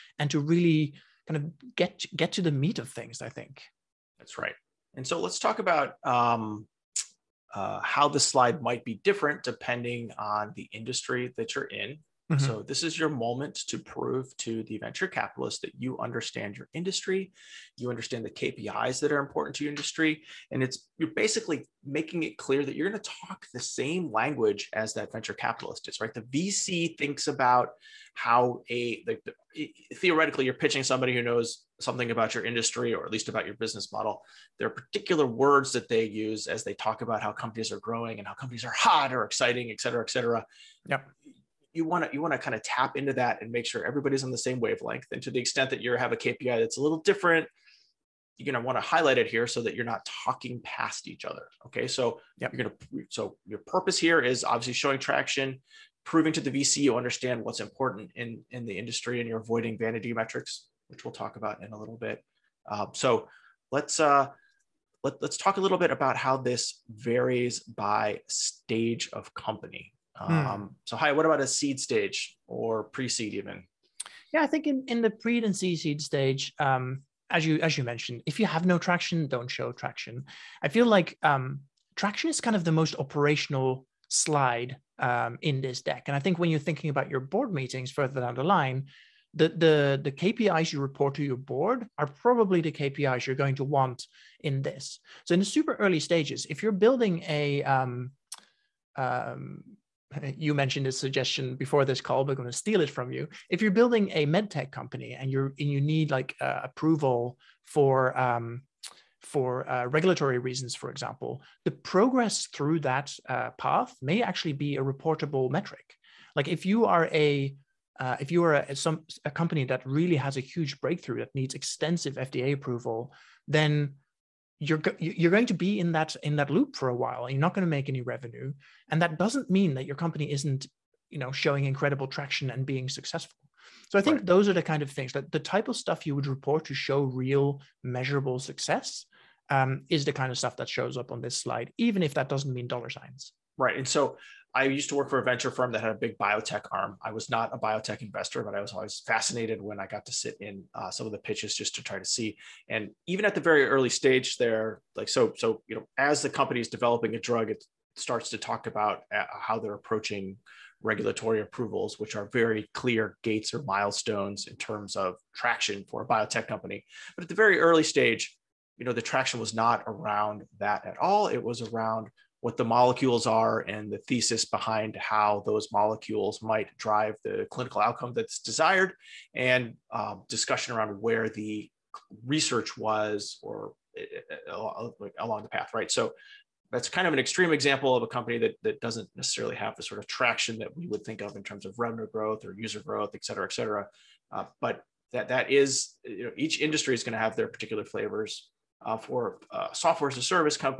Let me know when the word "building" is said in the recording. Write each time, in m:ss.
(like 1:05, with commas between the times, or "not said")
1:36, 1:43.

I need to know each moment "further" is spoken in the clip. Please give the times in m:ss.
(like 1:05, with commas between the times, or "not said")
1:27.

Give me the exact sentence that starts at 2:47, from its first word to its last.
But at the very early stage, you know, the traction was not around that at all.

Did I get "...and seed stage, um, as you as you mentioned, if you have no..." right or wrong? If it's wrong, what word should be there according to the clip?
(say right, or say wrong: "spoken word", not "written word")
right.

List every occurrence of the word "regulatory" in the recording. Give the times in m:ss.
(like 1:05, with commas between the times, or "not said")
1:49, 2:40.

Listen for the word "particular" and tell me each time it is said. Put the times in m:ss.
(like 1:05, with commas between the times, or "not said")
0:34, 3:17.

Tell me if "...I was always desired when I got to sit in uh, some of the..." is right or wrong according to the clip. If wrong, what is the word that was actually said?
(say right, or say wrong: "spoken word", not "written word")
wrong: "fascinated", not "desired".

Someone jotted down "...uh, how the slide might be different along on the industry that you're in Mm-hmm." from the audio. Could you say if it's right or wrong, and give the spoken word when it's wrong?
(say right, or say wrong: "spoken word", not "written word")
wrong: "depending", not "along".